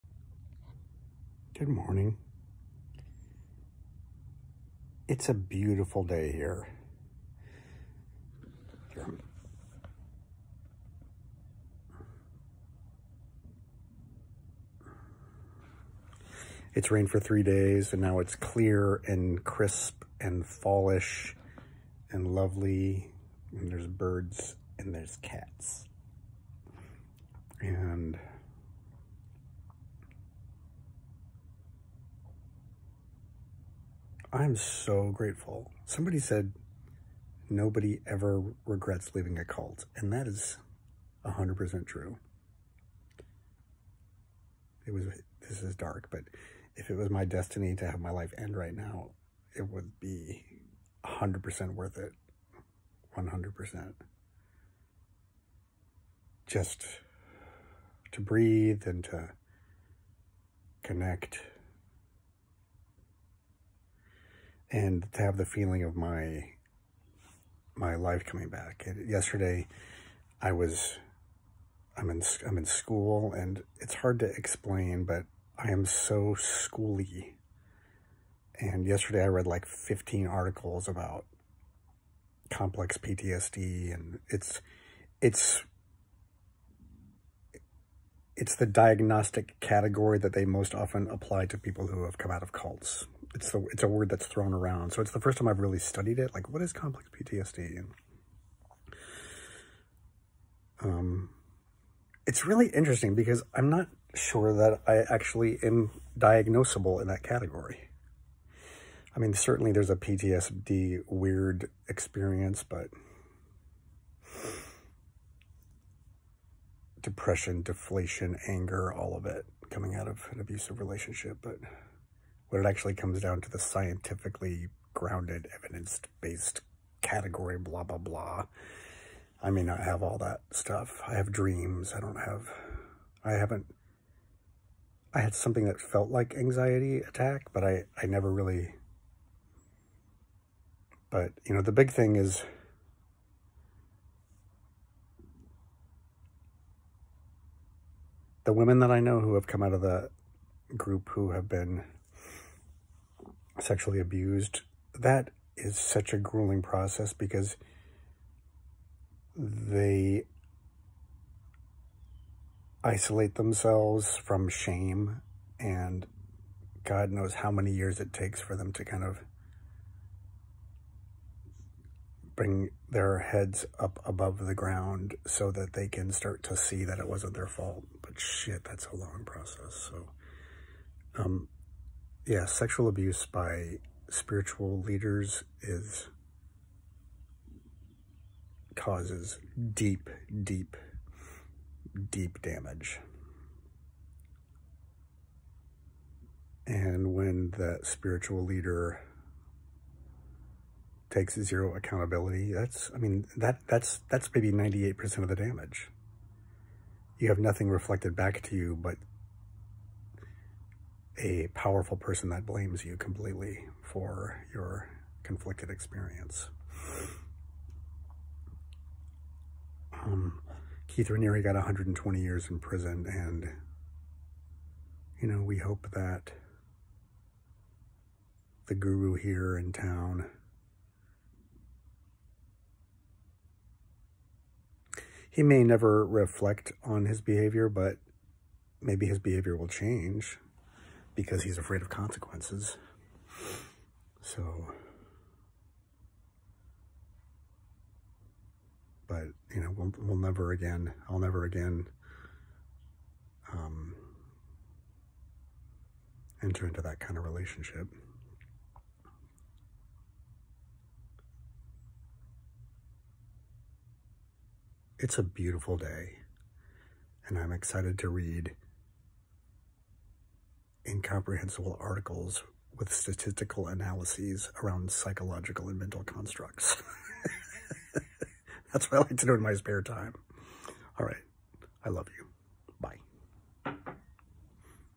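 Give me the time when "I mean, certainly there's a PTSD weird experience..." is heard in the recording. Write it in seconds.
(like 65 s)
109 s.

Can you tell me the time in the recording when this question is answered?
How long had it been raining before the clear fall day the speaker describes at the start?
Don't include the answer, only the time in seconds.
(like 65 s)
17 s.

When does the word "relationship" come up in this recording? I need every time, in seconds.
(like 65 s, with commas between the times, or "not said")
120 s, 257 s.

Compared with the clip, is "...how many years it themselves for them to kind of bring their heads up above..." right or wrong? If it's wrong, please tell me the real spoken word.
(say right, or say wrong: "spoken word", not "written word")
wrong: "takes", not "themselves".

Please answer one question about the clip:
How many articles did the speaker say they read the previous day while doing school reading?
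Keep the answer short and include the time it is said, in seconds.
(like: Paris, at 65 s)
15, at 79 s.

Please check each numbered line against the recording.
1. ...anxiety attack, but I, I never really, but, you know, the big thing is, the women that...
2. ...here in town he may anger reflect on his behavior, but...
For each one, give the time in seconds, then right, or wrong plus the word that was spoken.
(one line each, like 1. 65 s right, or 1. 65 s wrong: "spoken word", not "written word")
1. 136 s right
2. 229 s wrong: "never", not "anger".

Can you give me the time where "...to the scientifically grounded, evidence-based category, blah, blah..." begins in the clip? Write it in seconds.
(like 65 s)
123 s.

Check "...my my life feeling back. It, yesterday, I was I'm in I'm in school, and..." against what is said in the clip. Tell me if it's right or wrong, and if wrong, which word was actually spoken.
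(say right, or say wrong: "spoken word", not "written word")
wrong: "coming", not "feeling".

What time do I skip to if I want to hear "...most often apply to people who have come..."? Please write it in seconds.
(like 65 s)
90 s.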